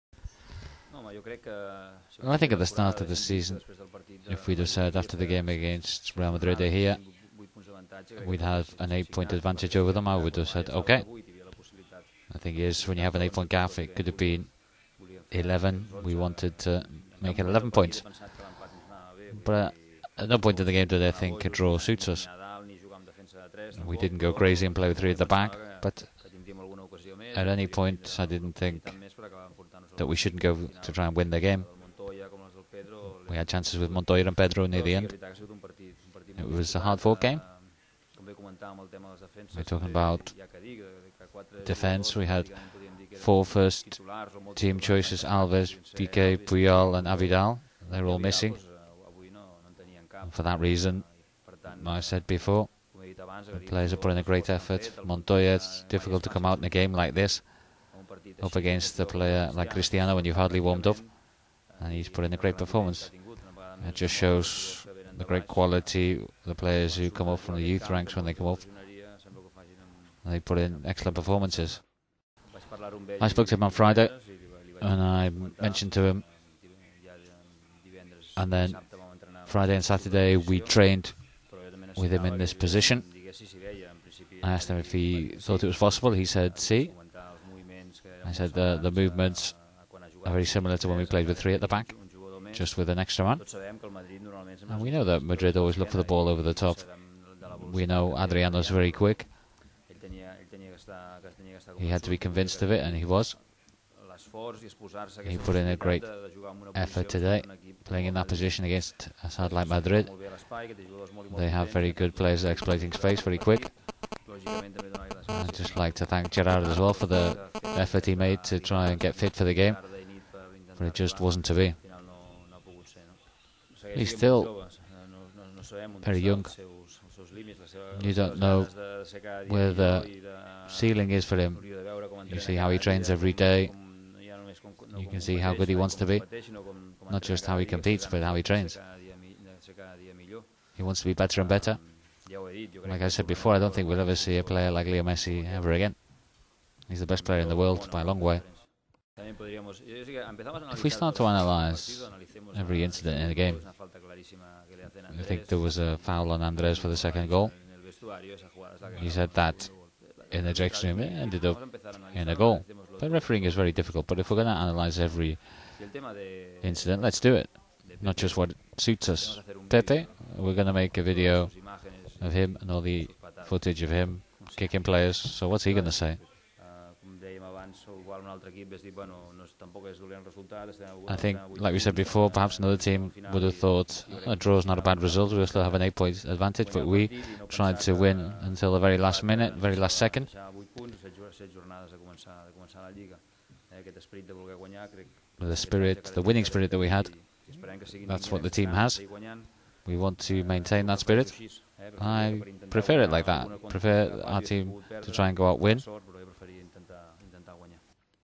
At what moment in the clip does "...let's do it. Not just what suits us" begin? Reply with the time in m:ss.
2:47.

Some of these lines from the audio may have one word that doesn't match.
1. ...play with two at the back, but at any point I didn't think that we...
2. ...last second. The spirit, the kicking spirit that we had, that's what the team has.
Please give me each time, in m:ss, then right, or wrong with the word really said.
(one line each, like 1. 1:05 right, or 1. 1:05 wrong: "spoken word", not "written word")
1. 0:24 wrong: "three", not "two"
2. 3:09 wrong: "winning", not "kicking".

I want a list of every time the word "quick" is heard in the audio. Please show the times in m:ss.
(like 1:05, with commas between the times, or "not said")
1:38, 1:53.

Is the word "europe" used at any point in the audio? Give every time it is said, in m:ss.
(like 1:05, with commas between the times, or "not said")
not said.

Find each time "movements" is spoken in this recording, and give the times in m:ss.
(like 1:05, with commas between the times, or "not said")
1:28.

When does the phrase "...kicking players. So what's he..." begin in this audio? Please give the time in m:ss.
2:54.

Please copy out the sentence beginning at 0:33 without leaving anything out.
We had chances with Montoya and Pedro near the end.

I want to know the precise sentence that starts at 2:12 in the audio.
You see how he trains every day.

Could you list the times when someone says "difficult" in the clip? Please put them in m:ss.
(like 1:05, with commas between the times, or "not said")
0:55, 2:43.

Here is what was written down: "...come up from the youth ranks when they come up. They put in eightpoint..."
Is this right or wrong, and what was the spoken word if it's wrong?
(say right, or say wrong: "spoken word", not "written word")
wrong: "excellent", not "eightpoint".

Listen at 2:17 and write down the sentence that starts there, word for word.
Not just how he competes, but how he trains.